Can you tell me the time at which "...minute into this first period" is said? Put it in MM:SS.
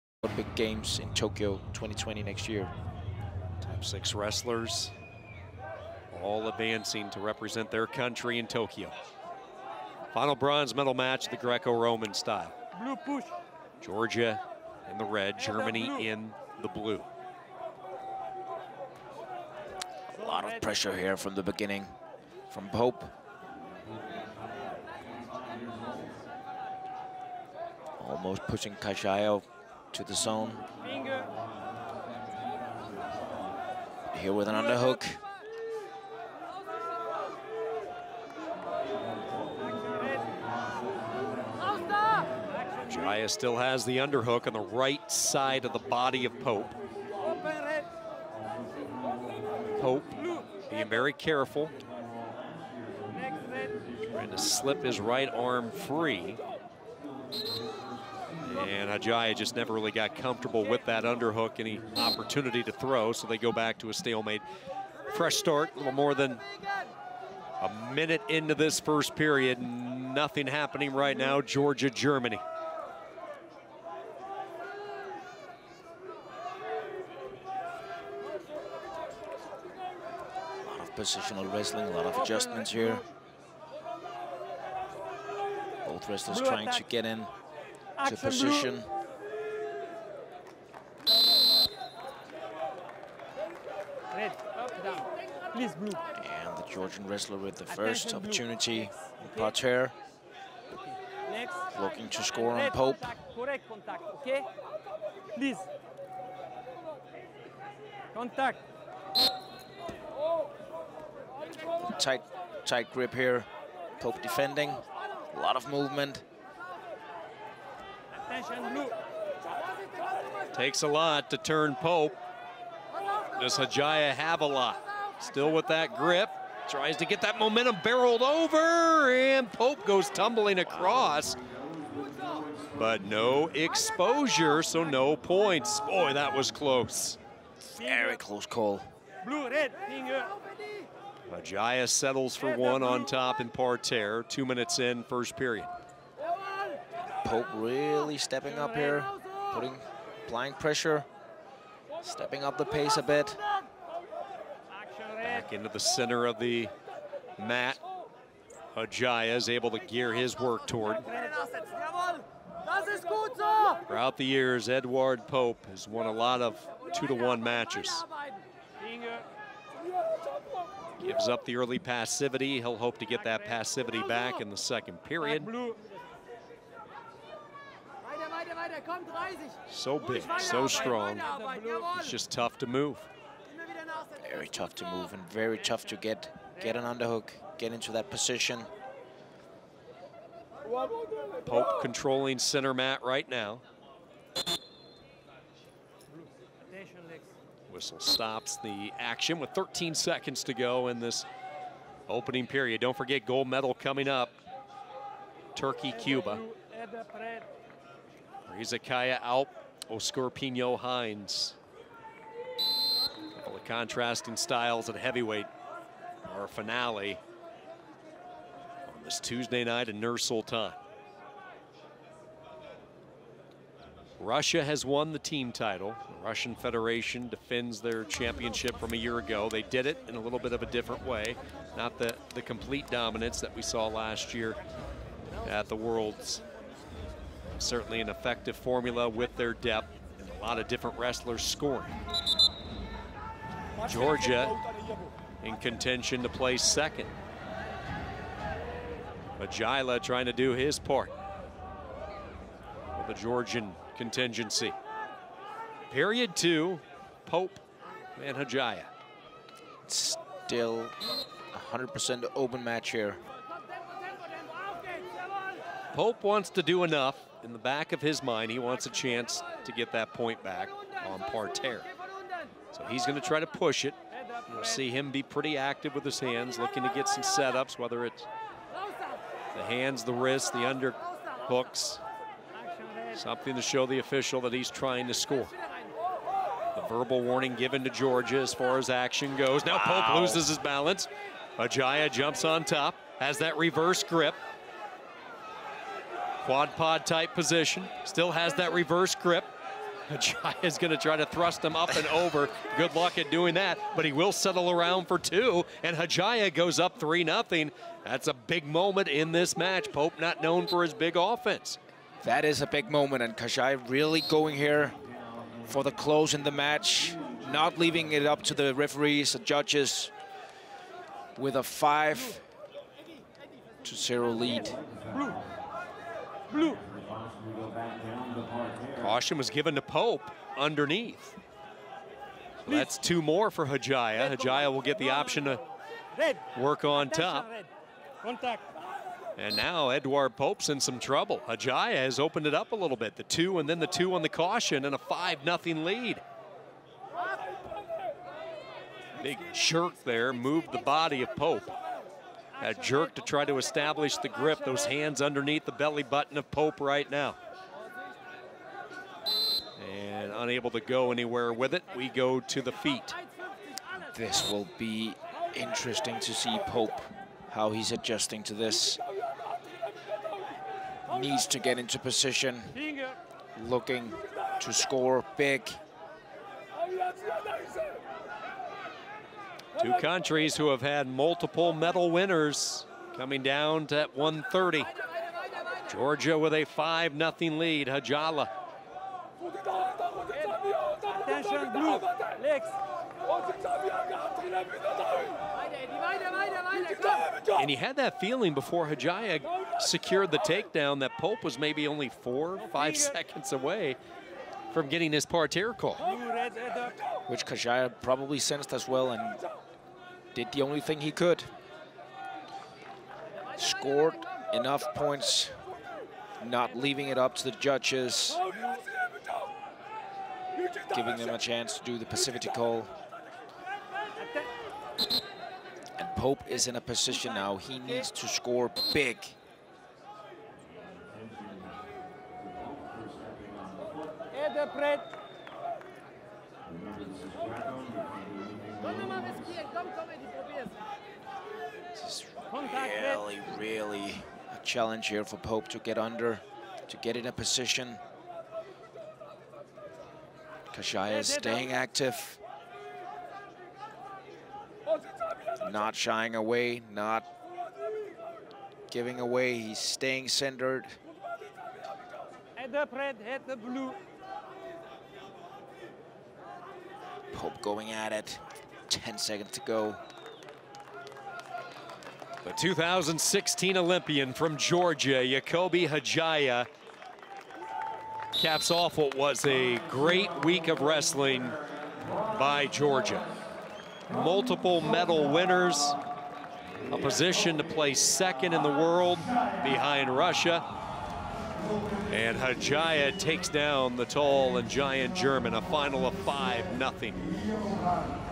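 01:07.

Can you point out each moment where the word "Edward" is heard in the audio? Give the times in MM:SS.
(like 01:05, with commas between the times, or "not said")
02:44.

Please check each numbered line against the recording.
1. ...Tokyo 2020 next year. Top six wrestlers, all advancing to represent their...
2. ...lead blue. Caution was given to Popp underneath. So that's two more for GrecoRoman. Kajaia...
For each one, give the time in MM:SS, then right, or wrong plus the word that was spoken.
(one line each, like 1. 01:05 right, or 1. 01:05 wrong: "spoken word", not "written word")
1. 00:01 right
2. 05:24 wrong: "Kajaia", not "GrecoRoman".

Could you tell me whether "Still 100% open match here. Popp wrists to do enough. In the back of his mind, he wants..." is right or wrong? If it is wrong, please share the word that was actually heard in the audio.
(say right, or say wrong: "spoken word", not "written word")
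wrong: "wants", not "wrists".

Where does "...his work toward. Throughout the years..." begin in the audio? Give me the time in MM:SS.
02:40.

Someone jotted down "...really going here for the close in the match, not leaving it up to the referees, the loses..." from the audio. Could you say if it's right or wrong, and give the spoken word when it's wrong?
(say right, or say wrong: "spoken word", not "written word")
wrong: "judges", not "loses".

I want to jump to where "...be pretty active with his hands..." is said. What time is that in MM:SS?
04:35.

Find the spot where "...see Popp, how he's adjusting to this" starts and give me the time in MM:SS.
06:06.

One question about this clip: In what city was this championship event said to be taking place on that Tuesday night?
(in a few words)
Nur Sultan.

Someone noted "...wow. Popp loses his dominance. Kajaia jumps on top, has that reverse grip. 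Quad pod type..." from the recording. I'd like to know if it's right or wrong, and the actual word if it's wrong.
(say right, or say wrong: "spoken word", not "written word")
wrong: "balance", not "dominance".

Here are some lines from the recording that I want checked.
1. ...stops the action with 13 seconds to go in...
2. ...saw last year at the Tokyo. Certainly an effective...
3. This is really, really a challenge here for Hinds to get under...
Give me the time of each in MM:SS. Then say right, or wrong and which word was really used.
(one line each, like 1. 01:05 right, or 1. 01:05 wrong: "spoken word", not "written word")
1. 03:17 right
2. 03:53 wrong: "Worlds", not "Tokyo"
3. 07:16 wrong: "Popp", not "Hinds".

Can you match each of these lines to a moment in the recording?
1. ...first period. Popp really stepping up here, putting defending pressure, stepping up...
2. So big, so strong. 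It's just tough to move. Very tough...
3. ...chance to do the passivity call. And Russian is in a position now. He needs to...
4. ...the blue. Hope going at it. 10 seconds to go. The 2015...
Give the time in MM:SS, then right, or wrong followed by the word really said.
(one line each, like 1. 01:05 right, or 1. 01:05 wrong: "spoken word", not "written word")
1. 02:25 wrong: "applying", not "defending"
2. 02:59 right
3. 07:01 wrong: "Popp", not "Russian"
4. 07:43 wrong: "2016", not "2015".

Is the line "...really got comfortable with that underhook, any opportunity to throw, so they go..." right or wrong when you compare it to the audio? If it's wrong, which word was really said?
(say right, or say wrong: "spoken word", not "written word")
right.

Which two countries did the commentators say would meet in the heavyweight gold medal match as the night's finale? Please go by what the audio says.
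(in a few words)
Turkey, Cuba.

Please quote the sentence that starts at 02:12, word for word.
But no exposure, so no points.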